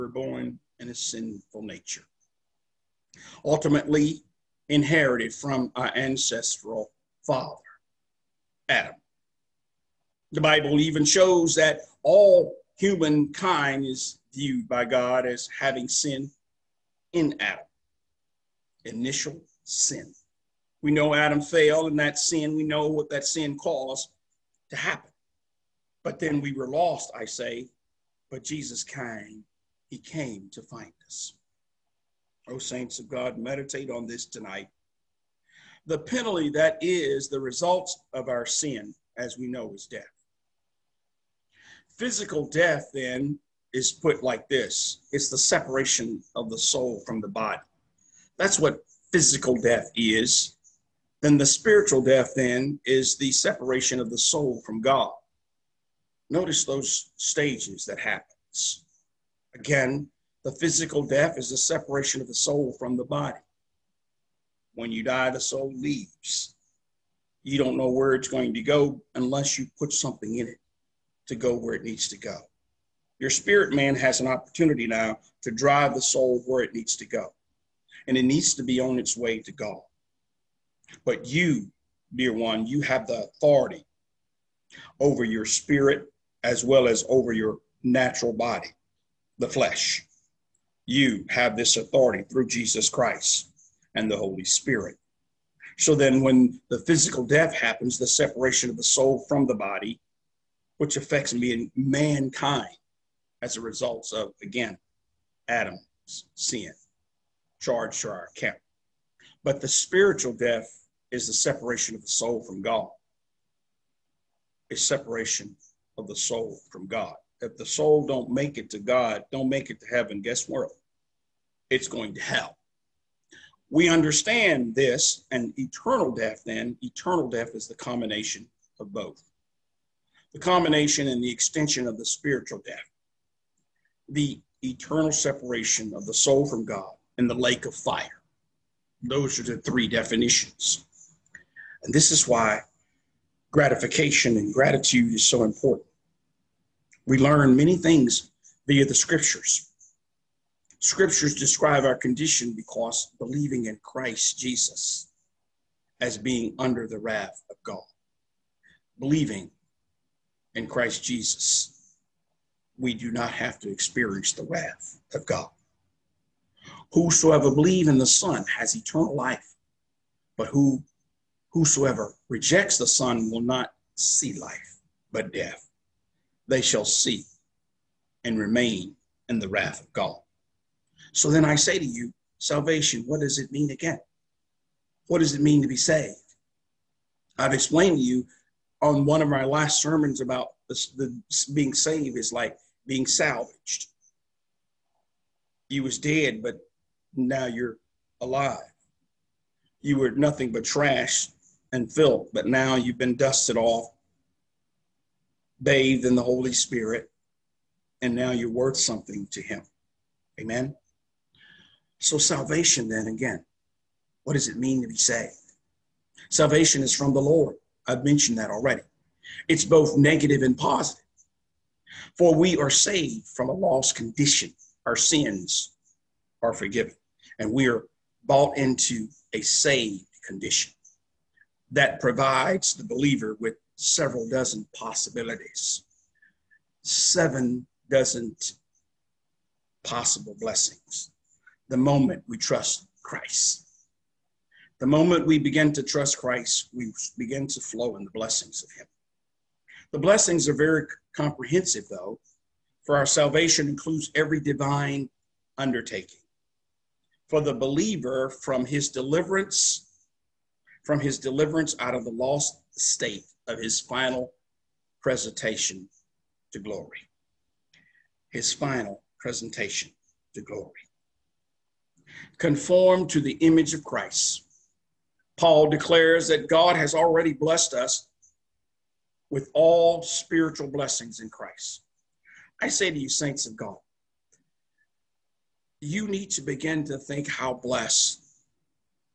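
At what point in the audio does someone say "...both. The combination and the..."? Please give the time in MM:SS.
02:08.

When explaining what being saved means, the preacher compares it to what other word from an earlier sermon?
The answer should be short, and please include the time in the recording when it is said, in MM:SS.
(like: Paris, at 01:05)
salvaged, at 03:13.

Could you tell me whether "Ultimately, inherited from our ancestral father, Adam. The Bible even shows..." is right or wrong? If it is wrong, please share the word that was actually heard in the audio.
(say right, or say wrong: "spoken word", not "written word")
right.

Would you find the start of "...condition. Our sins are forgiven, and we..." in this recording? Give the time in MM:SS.
03:43.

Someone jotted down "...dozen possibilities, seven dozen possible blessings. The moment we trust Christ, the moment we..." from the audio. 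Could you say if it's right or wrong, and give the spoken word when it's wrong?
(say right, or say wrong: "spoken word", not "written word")
right.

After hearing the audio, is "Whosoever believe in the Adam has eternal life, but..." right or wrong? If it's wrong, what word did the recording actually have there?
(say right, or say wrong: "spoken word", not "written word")
wrong: "Son", not "Adam".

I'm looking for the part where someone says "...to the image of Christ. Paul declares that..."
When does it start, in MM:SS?
04:33.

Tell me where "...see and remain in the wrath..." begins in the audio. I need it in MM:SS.
02:56.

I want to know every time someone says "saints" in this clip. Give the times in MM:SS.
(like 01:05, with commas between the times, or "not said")
00:32, 04:43.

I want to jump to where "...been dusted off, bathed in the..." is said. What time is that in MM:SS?
03:22.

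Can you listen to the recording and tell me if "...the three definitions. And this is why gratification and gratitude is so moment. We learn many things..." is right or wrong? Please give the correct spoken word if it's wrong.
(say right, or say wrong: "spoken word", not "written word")
wrong: "important", not "moment".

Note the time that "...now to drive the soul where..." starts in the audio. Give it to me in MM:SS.
01:14.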